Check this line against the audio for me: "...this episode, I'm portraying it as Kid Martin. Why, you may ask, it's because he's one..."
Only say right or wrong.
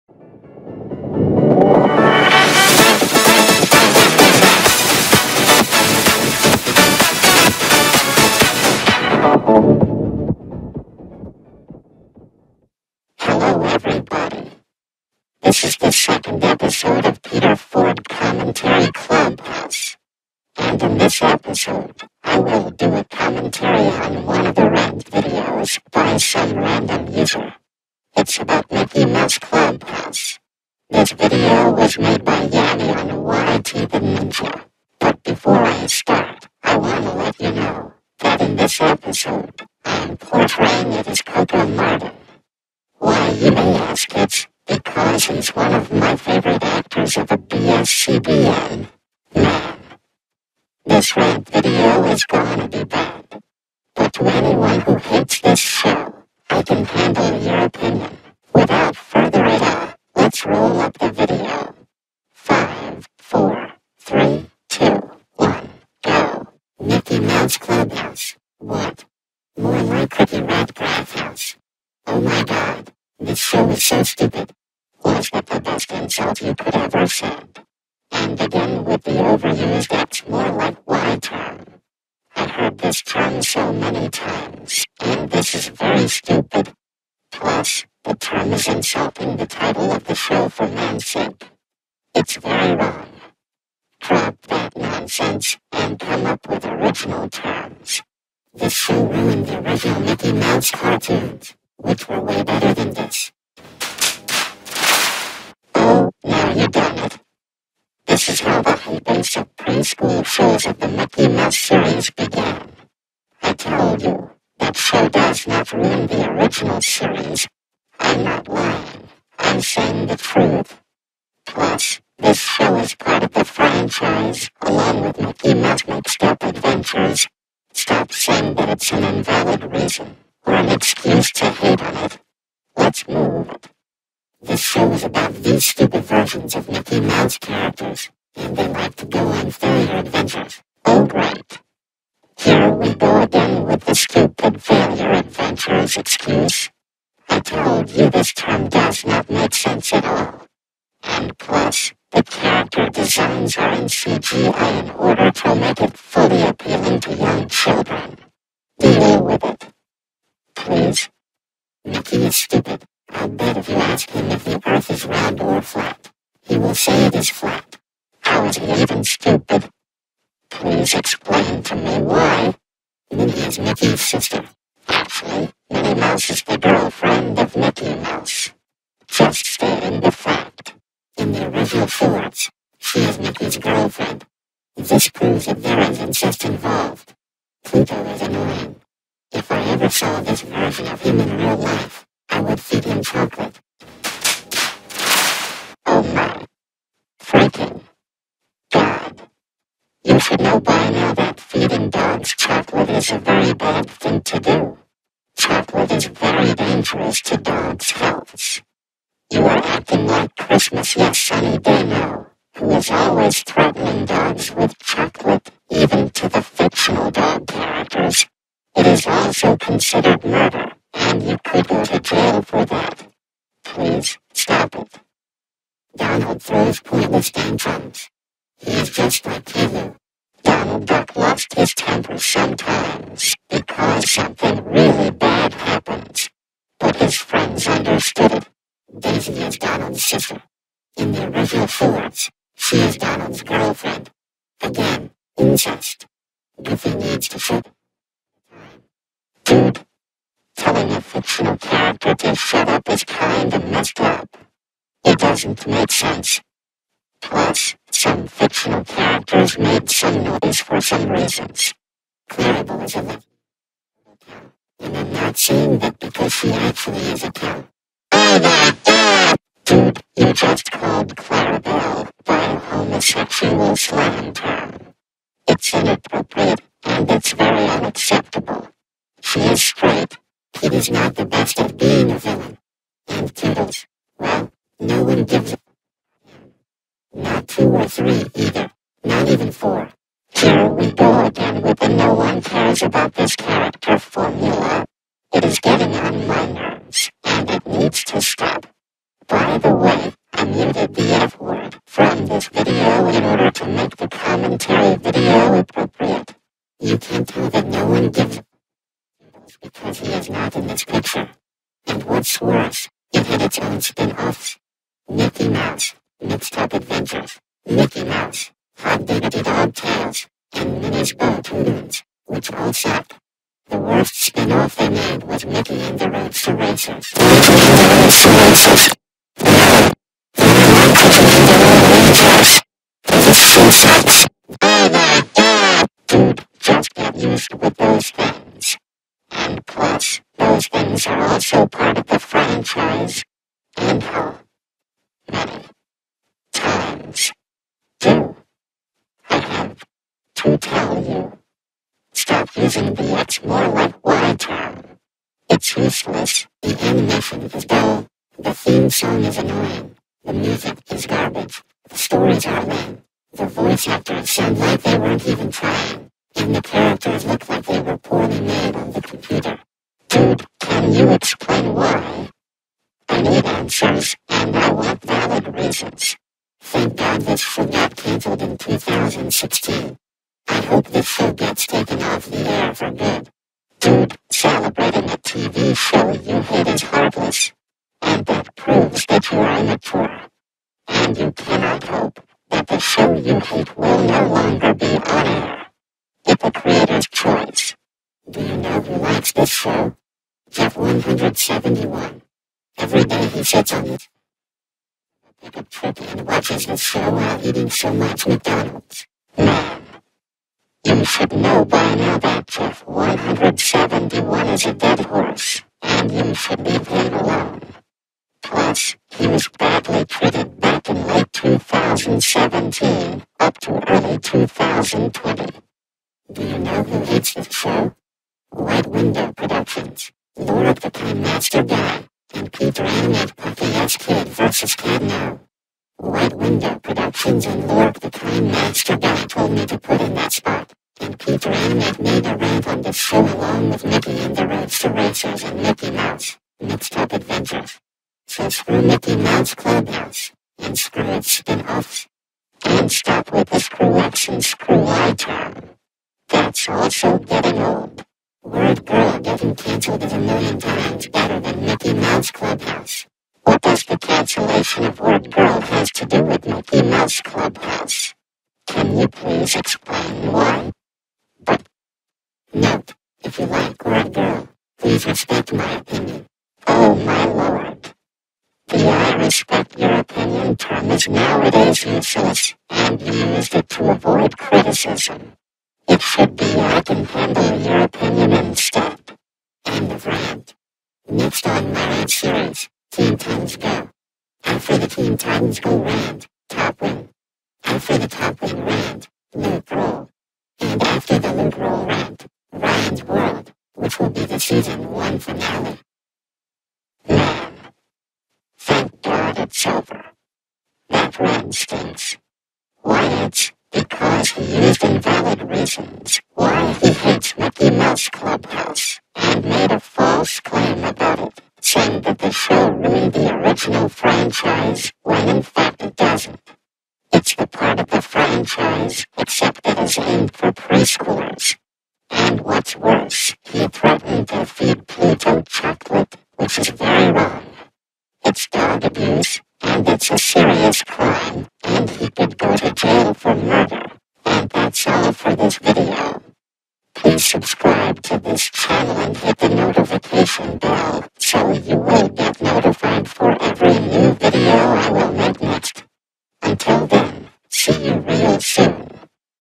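wrong.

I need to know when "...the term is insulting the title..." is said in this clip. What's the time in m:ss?
1:28.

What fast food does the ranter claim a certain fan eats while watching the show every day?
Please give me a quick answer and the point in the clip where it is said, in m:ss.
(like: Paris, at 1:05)
McDonald's, at 6:48.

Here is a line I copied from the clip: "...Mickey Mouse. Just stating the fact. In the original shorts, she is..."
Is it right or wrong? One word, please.
right.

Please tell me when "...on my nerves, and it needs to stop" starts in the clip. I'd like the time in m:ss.
4:55.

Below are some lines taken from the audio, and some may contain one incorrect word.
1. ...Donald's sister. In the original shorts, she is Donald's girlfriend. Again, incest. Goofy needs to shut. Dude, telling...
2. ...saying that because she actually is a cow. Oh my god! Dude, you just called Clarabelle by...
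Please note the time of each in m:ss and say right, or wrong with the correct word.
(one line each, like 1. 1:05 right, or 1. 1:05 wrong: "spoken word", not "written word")
1. 3:59 right
2. 4:25 right.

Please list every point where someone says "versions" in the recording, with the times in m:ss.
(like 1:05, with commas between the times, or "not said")
2:16, 3:10.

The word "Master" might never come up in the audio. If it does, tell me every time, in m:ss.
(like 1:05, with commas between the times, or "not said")
7:11, 7:18.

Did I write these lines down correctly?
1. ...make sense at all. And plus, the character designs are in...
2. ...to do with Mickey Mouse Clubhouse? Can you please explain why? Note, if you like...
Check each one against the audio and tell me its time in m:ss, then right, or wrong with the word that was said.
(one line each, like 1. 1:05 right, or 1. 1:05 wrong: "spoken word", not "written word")
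1. 2:29 right
2. 7:45 right.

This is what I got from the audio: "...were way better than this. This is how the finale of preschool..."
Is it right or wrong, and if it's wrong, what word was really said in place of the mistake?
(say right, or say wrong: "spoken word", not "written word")
wrong: "whole", not "finale".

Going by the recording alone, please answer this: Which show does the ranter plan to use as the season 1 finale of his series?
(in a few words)
Ryan's World.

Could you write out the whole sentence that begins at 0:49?
Man, this rant video is gonna be bad.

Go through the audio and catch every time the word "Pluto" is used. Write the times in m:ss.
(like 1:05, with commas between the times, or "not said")
3:07, 8:54.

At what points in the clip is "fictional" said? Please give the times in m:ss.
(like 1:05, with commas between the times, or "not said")
3:36, 4:11, 4:18.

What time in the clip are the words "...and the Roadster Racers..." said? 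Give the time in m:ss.
7:24.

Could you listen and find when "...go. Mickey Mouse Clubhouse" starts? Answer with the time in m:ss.
1:06.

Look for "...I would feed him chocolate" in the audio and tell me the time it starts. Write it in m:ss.
3:12.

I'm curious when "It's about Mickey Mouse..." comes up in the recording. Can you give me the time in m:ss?
0:28.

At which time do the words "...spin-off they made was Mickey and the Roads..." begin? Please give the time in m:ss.
5:24.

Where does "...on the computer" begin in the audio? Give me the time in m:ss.
6:08.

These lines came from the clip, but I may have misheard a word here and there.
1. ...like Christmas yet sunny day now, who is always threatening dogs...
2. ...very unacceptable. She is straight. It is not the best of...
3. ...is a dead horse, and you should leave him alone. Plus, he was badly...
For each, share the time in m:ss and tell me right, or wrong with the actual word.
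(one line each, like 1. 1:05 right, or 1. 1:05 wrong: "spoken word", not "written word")
1. 3:30 right
2. 4:37 right
3. 6:54 right.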